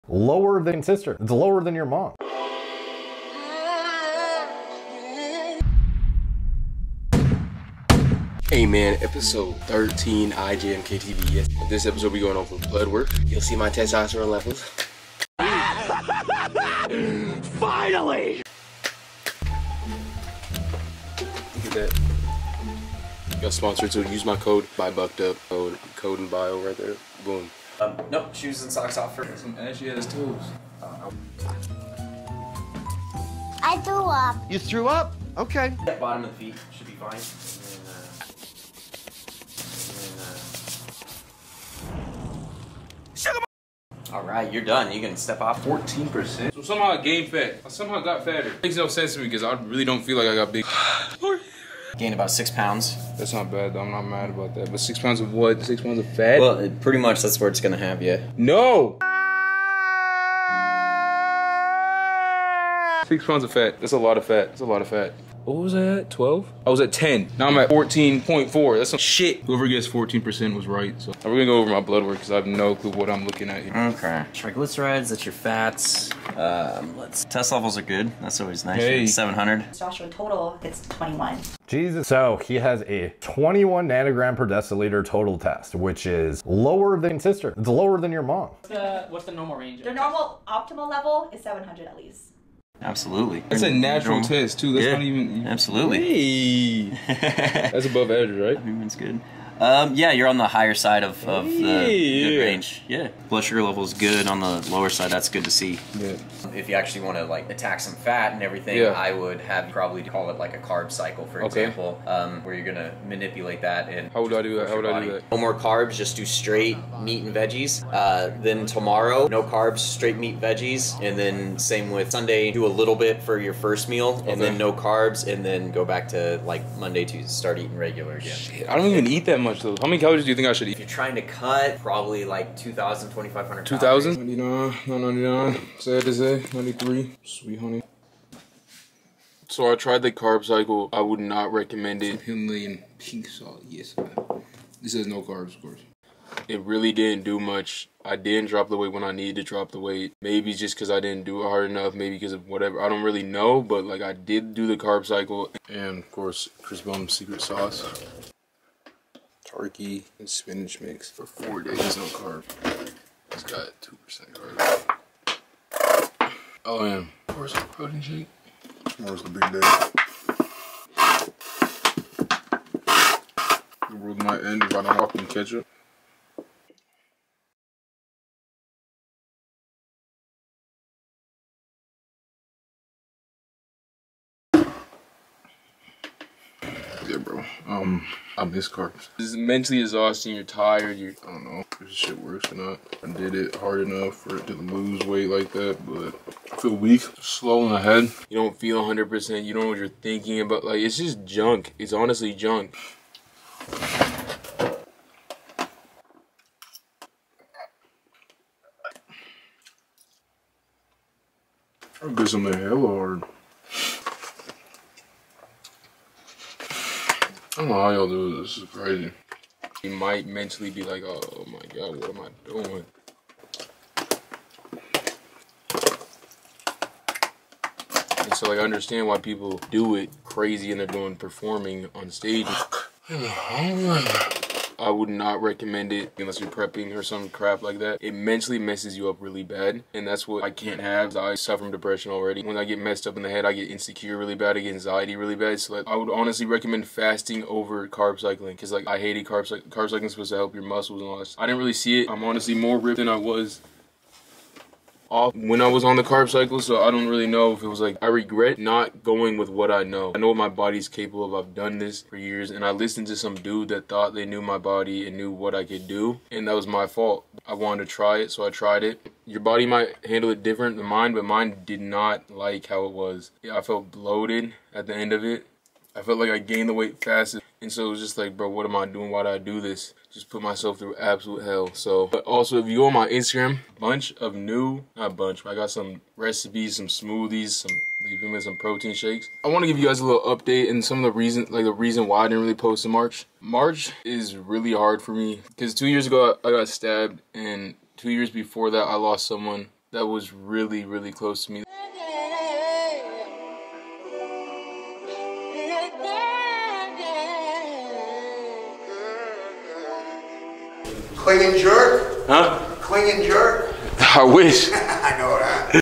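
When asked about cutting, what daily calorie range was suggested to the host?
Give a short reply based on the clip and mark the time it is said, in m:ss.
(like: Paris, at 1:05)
2,000 to 2,500, at 2:12.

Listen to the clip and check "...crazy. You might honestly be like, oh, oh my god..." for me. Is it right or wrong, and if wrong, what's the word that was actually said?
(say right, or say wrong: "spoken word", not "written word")
wrong: "mentally", not "honestly".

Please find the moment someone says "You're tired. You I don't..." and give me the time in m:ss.
3:10.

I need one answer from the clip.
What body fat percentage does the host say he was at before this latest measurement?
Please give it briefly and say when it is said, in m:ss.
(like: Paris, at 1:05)
10, at 1:06.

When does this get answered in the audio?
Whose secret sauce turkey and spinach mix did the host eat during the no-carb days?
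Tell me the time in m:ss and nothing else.
2:36.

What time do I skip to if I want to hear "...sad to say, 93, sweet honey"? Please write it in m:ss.
2:15.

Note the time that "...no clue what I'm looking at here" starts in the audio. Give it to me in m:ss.
1:12.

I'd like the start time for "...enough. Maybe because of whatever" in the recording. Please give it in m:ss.
2:31.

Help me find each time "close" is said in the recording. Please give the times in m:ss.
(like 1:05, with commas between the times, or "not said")
5:01.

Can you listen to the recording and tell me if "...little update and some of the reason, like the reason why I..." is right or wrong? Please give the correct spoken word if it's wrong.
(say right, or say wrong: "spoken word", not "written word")
right.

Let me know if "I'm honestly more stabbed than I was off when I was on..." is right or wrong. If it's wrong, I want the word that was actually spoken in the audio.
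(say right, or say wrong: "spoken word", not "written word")
wrong: "ripped", not "stabbed".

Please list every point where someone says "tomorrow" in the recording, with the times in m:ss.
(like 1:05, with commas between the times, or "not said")
1:58, 2:48.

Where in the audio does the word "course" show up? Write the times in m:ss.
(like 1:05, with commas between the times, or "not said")
2:25, 2:36.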